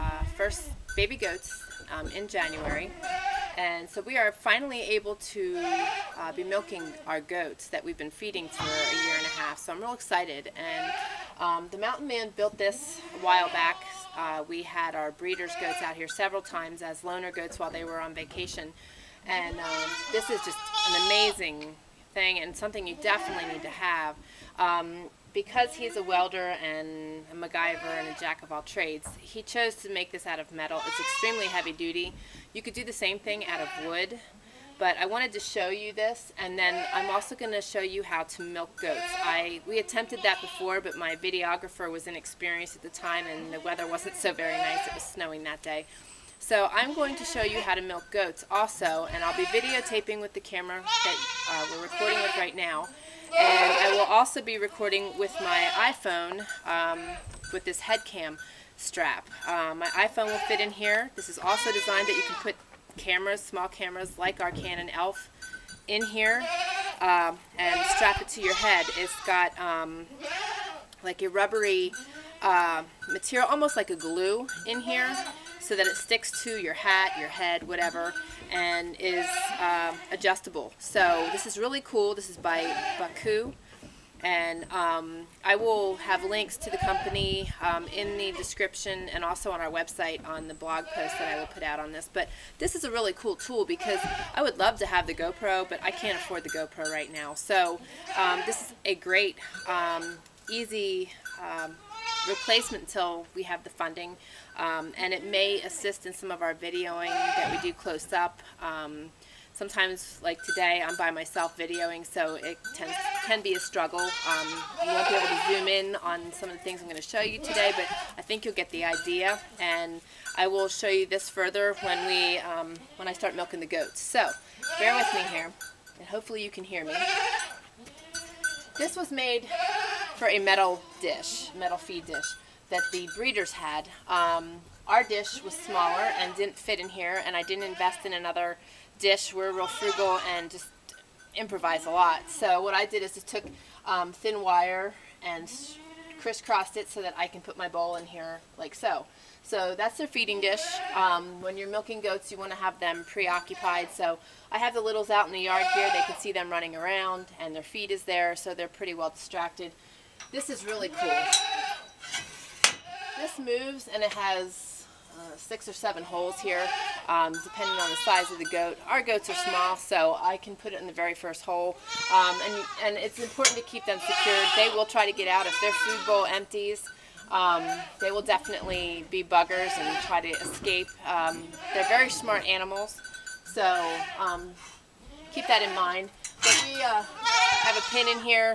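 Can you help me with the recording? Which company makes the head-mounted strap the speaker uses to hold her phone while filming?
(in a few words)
Baku.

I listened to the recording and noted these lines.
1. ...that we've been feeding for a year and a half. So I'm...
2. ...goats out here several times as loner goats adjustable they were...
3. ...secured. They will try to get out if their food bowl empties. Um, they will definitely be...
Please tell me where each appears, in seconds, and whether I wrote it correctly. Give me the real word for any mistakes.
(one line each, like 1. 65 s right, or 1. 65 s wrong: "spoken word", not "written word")
1. 7 s right
2. 15 s wrong: "while", not "adjustable"
3. 173 s right.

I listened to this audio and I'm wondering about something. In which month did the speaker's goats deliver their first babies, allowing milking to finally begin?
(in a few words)
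January.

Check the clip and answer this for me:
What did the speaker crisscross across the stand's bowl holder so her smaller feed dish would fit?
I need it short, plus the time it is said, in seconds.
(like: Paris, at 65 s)
Thin wire, at 144 s.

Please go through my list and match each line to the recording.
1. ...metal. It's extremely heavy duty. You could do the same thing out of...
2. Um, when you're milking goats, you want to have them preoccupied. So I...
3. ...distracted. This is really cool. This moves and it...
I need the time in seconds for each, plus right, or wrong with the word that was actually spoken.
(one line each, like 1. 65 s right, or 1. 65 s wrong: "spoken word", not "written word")
1. 30 s right
2. 150 s right
3. 159 s right.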